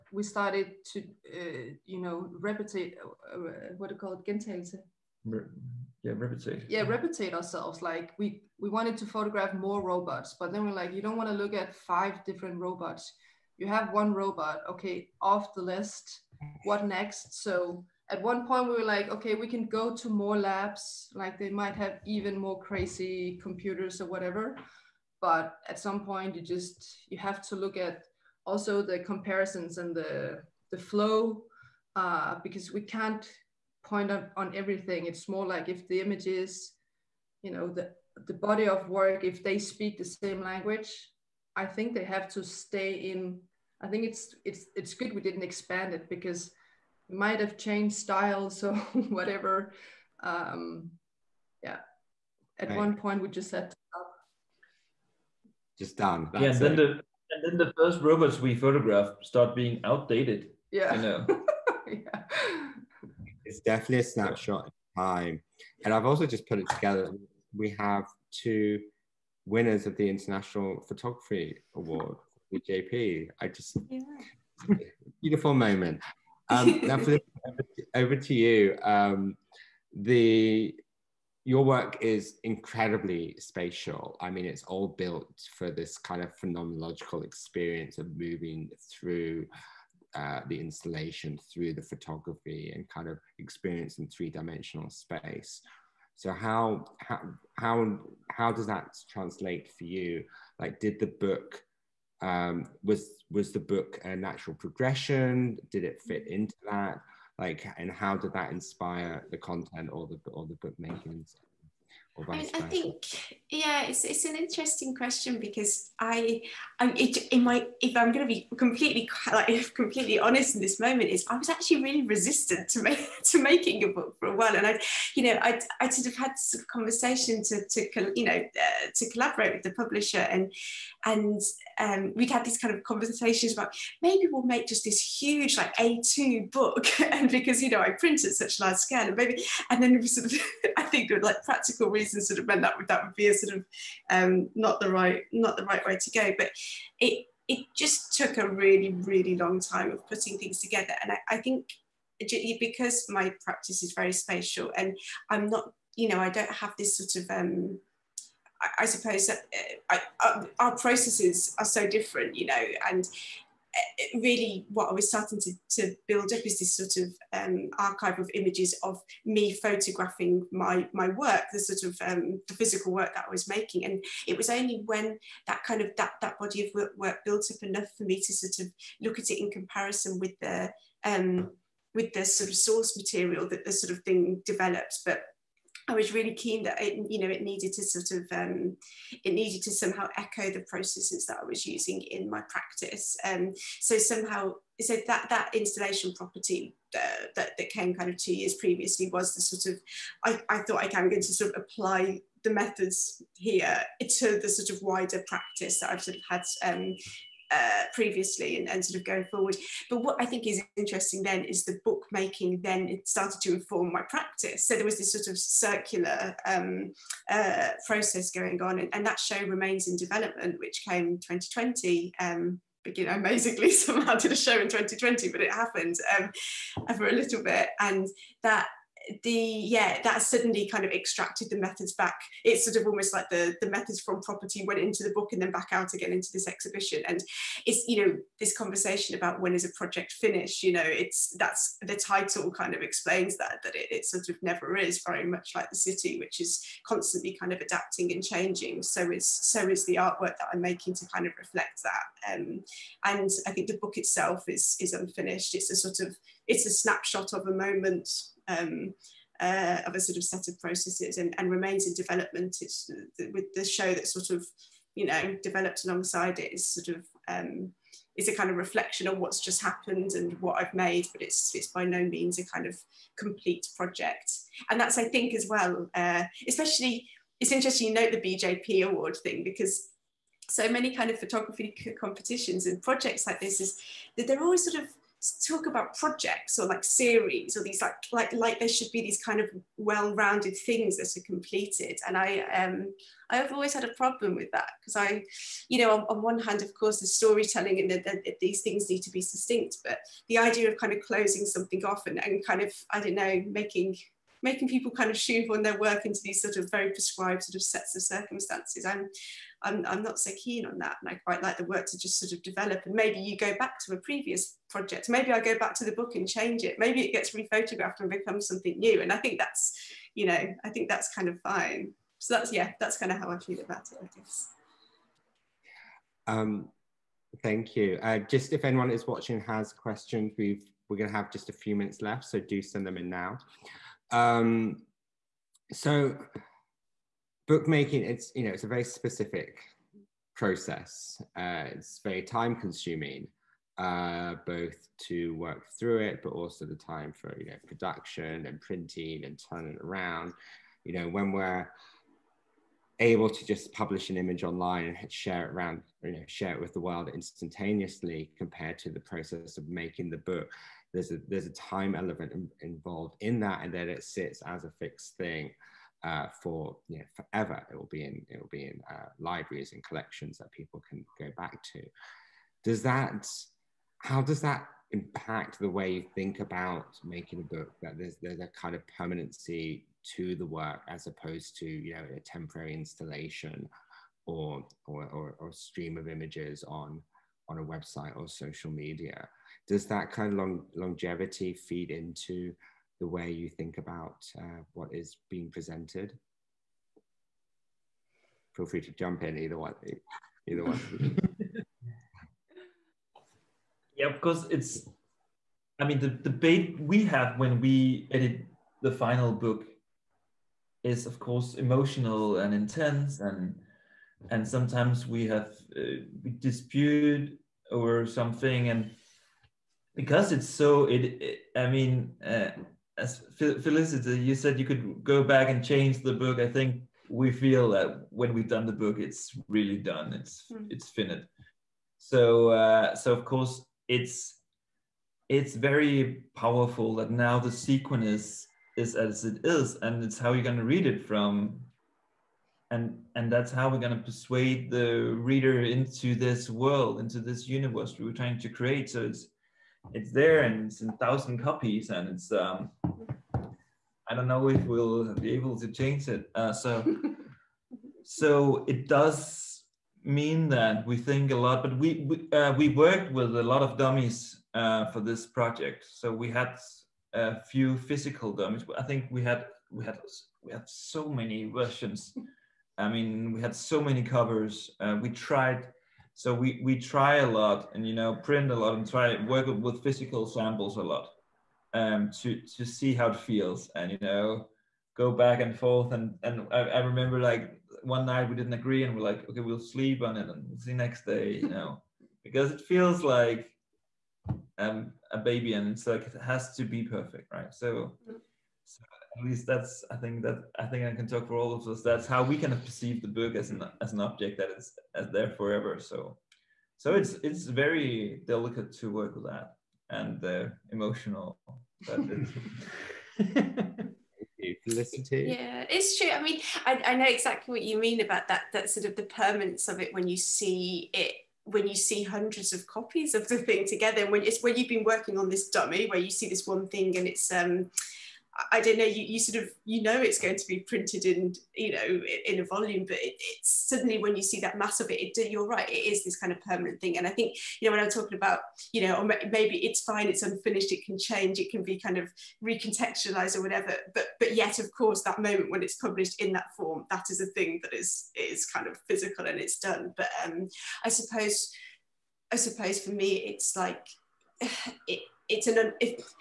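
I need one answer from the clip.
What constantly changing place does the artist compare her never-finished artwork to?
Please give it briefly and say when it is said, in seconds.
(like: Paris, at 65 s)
the city, at 245 s.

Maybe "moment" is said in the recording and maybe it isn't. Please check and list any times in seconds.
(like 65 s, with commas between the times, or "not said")
75 s, 120 s, 257 s, 545 s.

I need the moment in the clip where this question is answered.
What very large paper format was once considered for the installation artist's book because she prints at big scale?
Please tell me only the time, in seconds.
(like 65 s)
135 s.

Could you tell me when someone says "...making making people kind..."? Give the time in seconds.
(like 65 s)
303 s.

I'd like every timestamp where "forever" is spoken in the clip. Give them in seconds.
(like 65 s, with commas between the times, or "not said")
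367 s, 505 s.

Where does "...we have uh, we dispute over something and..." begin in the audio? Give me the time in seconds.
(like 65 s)
415 s.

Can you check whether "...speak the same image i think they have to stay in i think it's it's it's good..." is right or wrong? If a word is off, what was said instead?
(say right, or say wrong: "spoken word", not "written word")
wrong: "language", not "image".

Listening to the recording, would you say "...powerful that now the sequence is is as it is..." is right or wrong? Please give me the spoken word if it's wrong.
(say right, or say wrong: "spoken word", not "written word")
right.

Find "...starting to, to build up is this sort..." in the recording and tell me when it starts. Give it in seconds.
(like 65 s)
165 s.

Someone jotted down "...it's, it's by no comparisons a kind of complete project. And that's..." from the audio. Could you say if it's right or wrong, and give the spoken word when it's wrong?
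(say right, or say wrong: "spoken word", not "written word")
wrong: "means", not "comparisons".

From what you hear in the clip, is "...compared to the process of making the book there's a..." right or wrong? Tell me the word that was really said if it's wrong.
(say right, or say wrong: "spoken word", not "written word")
right.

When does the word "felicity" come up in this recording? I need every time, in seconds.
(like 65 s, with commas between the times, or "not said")
423 s, 514 s.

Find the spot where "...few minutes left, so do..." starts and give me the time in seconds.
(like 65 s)
331 s.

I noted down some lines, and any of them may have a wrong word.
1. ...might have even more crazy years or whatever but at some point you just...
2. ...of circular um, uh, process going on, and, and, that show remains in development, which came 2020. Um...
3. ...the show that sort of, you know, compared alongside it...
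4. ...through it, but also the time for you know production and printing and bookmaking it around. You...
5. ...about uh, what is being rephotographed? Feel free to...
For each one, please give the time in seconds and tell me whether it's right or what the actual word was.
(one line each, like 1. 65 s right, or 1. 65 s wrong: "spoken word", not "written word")
1. 21 s wrong: "computers", not "years"
2. 215 s right
3. 263 s wrong: "developed", not "compared"
4. 345 s wrong: "turning", not "bookmaking"
5. 393 s wrong: "presented", not "rephotographed".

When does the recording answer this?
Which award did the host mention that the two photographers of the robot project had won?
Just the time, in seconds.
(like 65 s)
70 s.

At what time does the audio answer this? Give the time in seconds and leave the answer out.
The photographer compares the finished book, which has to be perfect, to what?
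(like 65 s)
495 s.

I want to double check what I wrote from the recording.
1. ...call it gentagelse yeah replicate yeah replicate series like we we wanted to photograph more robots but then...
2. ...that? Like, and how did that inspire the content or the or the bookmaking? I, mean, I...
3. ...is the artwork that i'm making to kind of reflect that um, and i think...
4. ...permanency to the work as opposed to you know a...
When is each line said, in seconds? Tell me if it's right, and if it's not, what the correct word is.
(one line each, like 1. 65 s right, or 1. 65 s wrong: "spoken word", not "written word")
1. 3 s wrong: "ourselves", not "series"
2. 106 s right
3. 249 s right
4. 378 s right.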